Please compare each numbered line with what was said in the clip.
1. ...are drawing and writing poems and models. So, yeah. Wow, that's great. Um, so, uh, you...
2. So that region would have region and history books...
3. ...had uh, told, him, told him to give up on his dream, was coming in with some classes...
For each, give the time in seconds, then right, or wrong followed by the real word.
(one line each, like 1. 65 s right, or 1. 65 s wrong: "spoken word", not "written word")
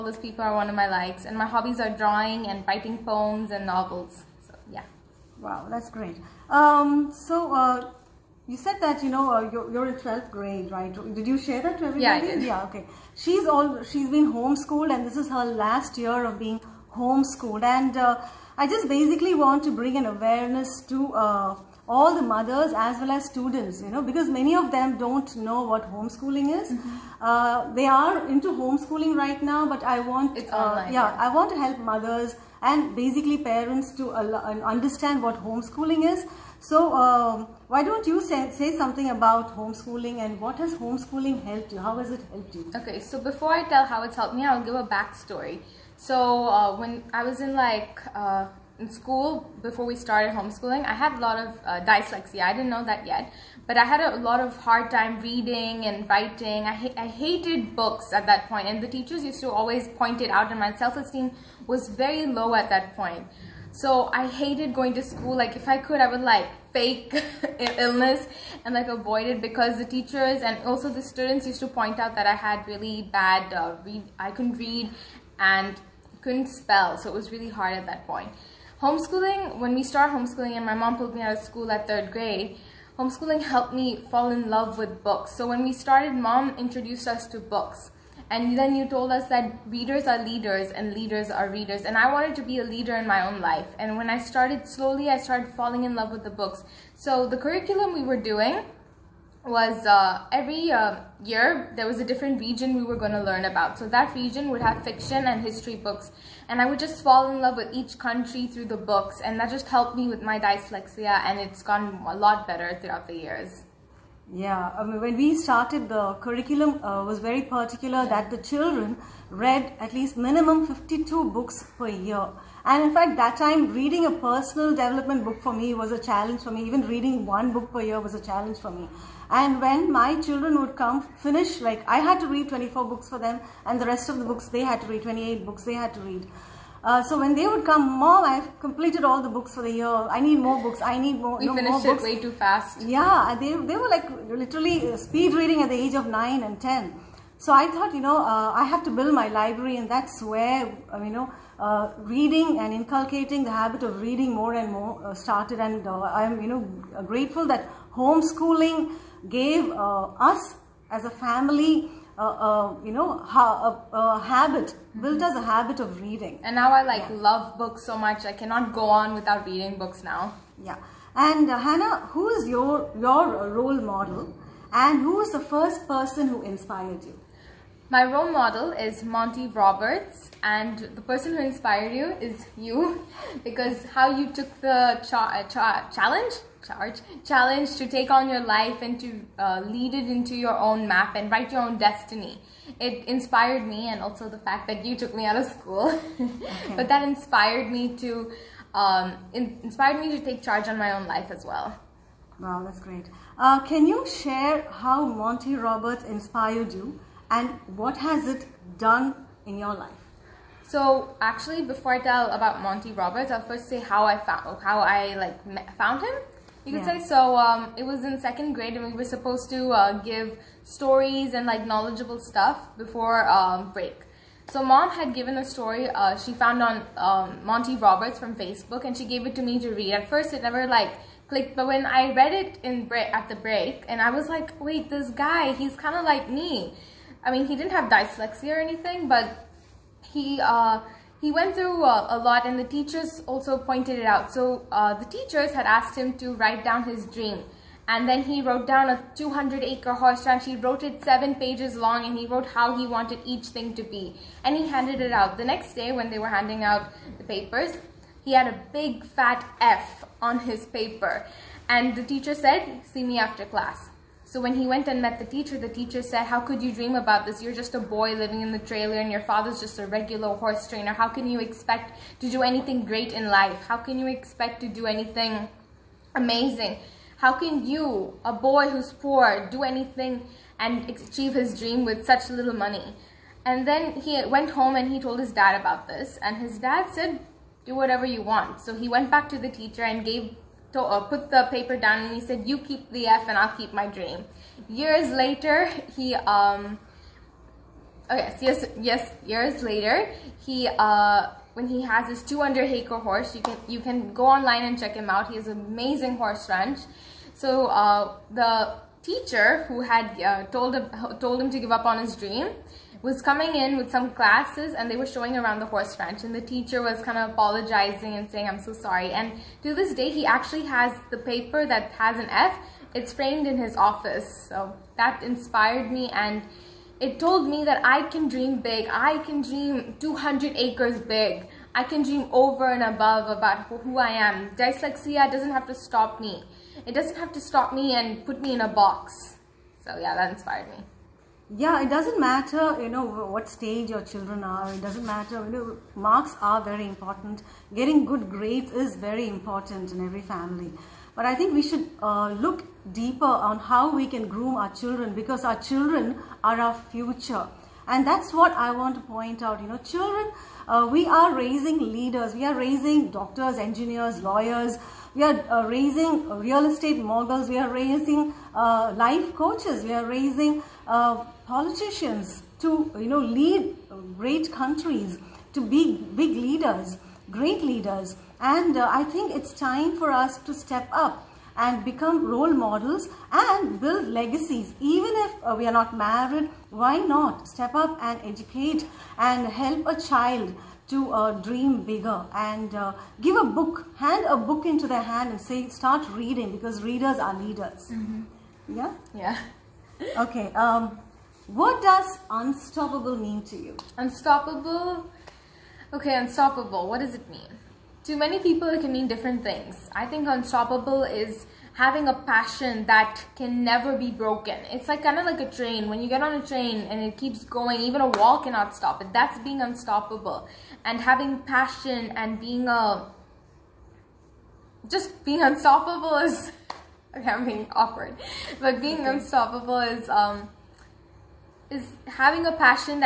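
1. 1 s wrong: "novels", not "models"
2. 103 s wrong: "fiction", not "region"
3. 309 s right.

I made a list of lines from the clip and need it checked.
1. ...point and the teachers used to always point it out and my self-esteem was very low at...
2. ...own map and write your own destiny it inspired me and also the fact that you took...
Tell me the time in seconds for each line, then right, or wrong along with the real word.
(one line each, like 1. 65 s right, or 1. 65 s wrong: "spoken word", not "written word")
1. 58 s right
2. 190 s right.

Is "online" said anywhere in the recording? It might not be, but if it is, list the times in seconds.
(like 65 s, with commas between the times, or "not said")
30 s, 304 s.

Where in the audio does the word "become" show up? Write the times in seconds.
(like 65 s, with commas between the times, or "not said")
381 s.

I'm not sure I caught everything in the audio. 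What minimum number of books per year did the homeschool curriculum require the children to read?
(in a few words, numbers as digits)
52.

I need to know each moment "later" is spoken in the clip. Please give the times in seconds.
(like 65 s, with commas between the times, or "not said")
295 s, 299 s.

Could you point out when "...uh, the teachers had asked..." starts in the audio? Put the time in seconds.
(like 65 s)
244 s.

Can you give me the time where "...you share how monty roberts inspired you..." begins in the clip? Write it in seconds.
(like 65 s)
203 s.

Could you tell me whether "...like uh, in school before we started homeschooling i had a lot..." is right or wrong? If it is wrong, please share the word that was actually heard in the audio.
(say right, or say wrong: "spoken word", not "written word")
right.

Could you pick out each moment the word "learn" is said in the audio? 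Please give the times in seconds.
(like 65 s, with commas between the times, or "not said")
103 s.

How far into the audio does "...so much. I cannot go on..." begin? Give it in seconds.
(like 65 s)
167 s.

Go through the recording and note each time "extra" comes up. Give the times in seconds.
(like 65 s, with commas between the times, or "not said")
not said.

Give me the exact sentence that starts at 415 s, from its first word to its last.
When you get on a train and it keeps going, even a wall cannot stop it.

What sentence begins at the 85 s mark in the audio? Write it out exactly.
So when we started, mom introduced us to books.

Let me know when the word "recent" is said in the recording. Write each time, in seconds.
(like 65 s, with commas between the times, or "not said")
not said.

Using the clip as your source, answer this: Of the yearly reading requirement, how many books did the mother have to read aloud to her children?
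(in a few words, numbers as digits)
24.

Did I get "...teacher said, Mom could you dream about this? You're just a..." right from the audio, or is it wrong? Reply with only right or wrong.
wrong.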